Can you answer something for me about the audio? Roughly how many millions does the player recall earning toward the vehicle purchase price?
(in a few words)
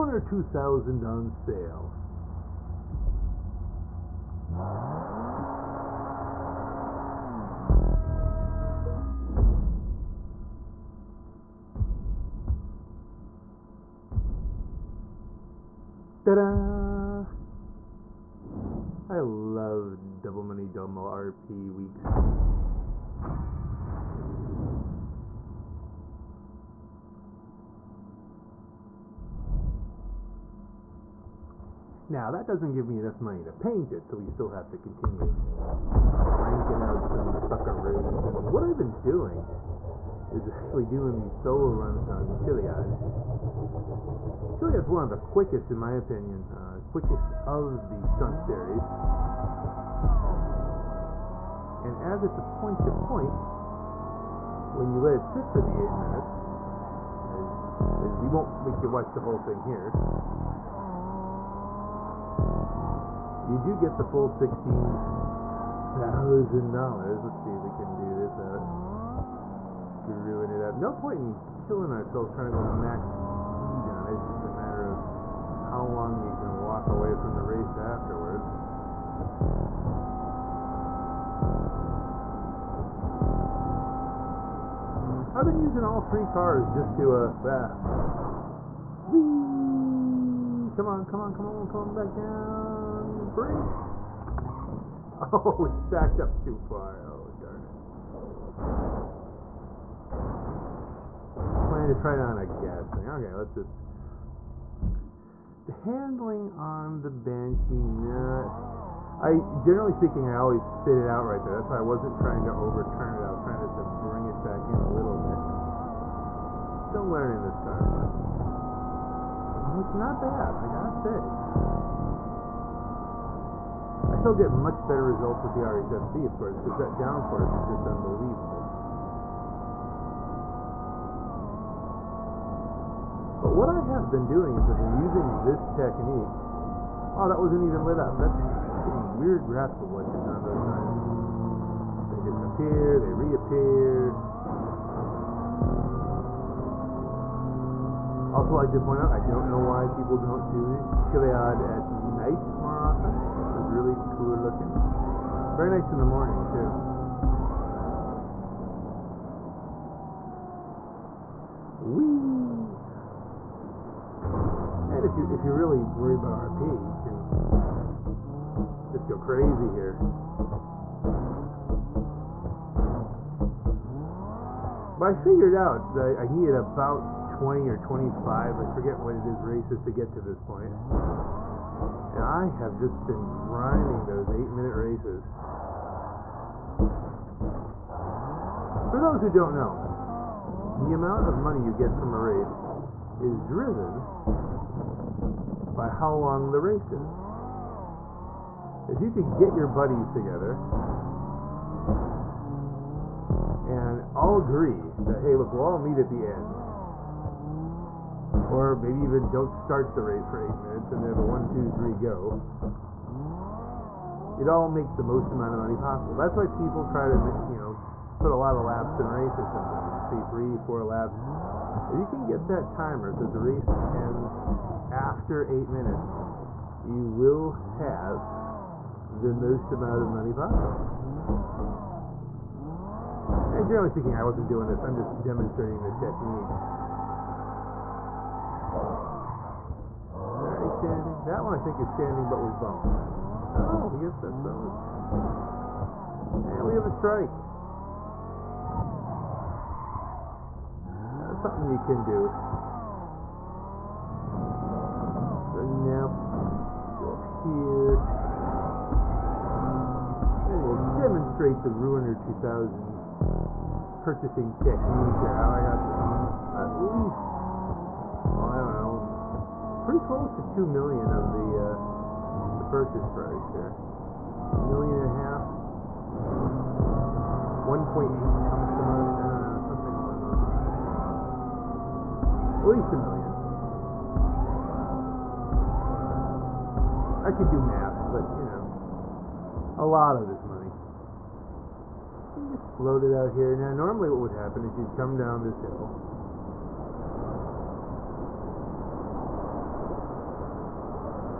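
1.8.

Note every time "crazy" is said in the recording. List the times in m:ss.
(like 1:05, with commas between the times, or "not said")
2:49.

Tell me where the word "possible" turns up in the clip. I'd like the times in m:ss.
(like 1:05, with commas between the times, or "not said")
3:35, 3:50.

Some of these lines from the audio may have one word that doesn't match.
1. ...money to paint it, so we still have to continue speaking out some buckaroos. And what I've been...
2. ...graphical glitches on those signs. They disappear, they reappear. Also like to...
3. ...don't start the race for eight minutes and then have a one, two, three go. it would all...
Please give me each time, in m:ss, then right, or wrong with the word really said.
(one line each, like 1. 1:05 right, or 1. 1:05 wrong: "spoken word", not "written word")
1. 0:33 wrong: "ranking", not "speaking"
2. 2:19 right
3. 3:29 right.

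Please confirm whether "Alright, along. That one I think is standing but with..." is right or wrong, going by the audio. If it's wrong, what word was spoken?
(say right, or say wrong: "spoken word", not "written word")
wrong: "standing", not "along".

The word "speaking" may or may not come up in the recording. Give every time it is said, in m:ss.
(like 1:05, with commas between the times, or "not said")
1:49, 3:53.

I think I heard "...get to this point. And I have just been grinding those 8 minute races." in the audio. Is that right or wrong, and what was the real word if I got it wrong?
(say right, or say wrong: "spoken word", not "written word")
right.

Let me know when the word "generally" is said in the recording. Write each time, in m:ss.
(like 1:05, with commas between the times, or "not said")
1:49, 3:53.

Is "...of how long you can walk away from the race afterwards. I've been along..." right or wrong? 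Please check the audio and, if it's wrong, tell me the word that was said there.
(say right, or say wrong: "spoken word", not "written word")
wrong: "using", not "along".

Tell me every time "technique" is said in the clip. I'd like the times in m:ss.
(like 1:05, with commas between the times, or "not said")
2:15, 3:55, 4:24.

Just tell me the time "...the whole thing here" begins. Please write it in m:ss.
0:59.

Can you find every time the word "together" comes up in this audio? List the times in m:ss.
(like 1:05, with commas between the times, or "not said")
3:20.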